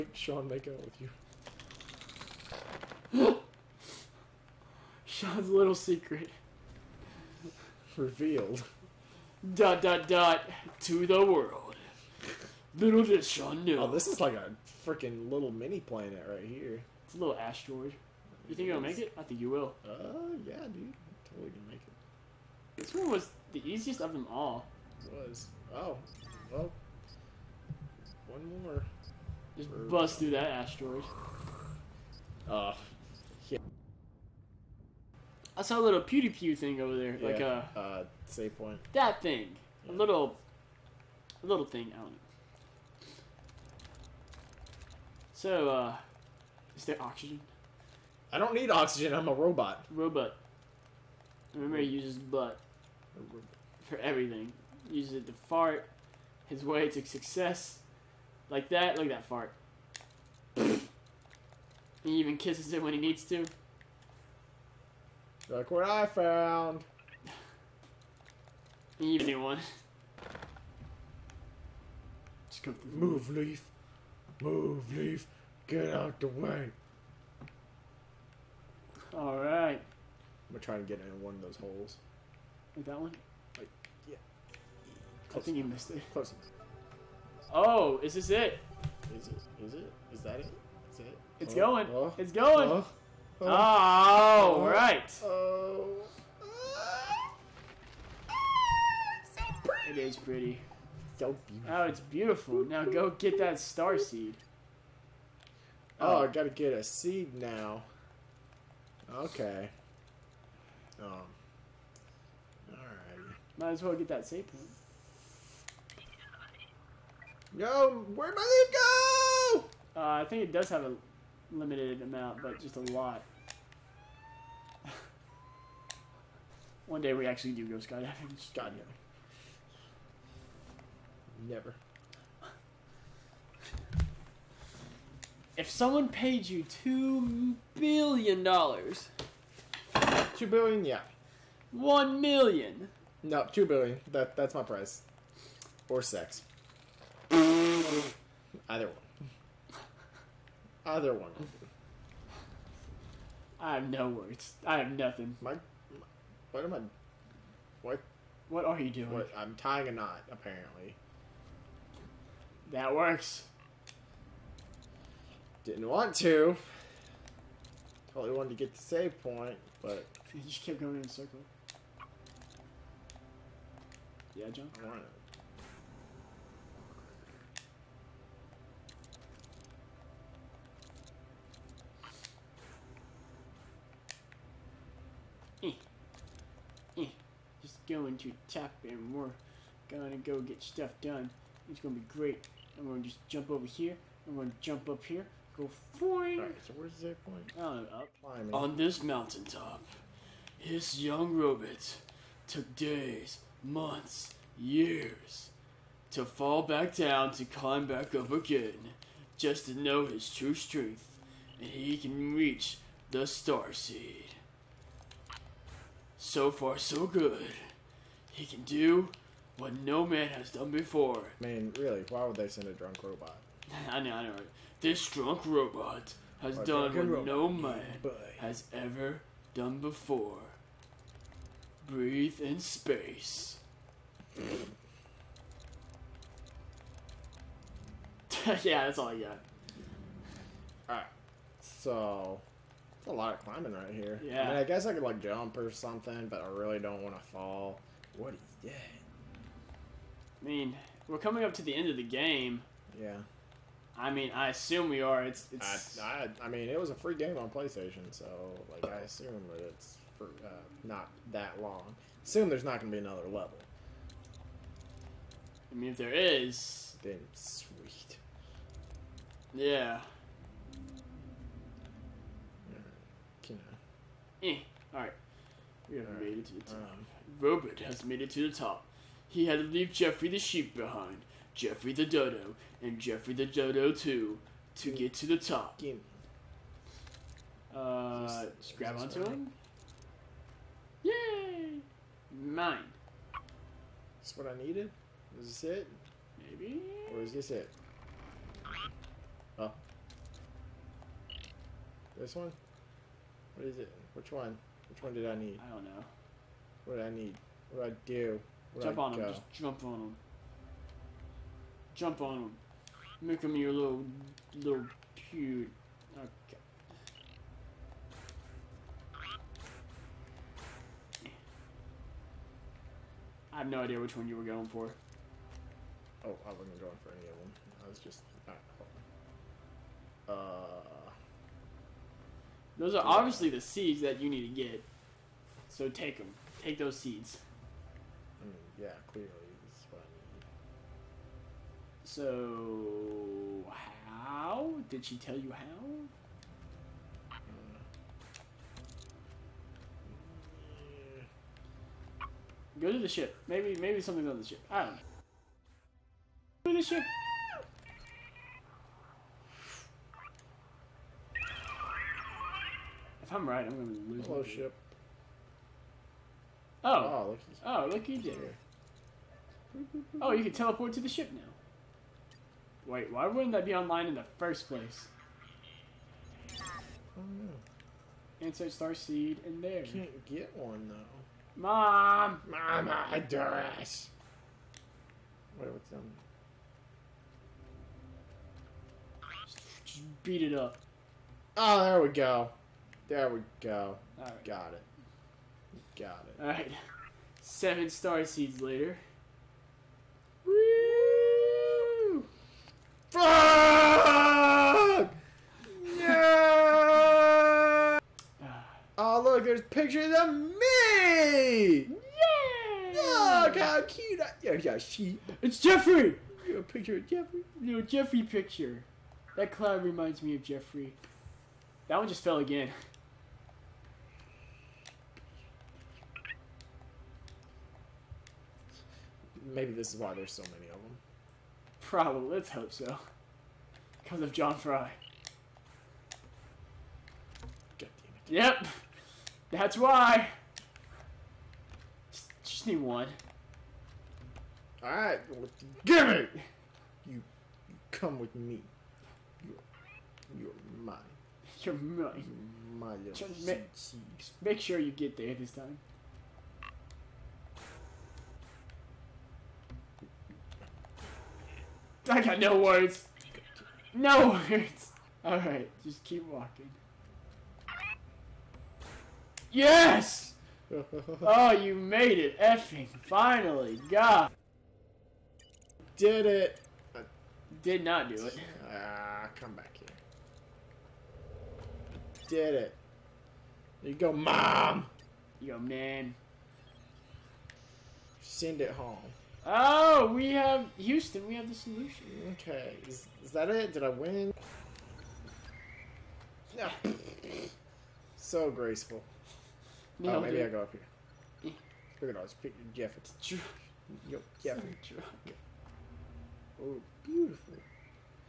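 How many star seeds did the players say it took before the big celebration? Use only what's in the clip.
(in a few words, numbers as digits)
7.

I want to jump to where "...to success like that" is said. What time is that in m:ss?
0:56.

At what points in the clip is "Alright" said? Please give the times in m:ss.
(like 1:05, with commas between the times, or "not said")
1:19, 1:52, 3:16, 4:00, 7:24, 7:45.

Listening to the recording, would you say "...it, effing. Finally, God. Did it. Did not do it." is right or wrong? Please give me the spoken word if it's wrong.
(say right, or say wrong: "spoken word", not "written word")
right.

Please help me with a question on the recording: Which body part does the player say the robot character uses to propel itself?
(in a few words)
butt.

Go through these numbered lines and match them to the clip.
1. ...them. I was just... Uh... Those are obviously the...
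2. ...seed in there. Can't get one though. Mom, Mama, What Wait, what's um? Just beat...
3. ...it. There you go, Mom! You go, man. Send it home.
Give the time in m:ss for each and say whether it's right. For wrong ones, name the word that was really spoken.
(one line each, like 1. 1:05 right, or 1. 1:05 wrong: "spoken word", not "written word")
1. 5:27 right
2. 6:18 right
3. 8:02 right.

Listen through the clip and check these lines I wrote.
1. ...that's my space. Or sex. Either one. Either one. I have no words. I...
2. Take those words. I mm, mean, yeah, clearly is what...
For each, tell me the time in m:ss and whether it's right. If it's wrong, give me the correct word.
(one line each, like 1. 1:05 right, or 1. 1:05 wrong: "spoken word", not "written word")
1. 2:24 wrong: "price", not "space"
2. 5:36 wrong: "seeds", not "words".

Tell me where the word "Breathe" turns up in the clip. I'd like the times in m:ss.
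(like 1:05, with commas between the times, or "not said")
3:51.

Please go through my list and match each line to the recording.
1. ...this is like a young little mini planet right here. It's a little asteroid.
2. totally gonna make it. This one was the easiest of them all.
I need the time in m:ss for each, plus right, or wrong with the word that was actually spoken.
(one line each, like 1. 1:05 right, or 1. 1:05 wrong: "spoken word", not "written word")
1. 0:13 wrong: "freaking", not "young"
2. 0:21 right.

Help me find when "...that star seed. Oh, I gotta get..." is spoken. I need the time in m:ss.
1:43.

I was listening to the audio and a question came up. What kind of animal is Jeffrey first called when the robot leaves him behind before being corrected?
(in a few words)
sheep.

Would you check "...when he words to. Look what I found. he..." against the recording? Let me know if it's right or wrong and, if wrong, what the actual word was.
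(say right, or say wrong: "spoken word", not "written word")
wrong: "needs", not "words".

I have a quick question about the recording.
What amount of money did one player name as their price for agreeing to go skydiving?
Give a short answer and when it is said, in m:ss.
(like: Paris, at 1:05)
2 billion dollars, at 2:16.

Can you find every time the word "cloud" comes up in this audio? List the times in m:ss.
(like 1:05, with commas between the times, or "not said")
6:59.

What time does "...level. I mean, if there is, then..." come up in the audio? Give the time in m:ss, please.
4:23.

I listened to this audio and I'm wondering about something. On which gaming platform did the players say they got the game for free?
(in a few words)
PlayStation.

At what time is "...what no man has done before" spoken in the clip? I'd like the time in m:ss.
3:39.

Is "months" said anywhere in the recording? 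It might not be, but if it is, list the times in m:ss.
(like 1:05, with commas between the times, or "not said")
3:23.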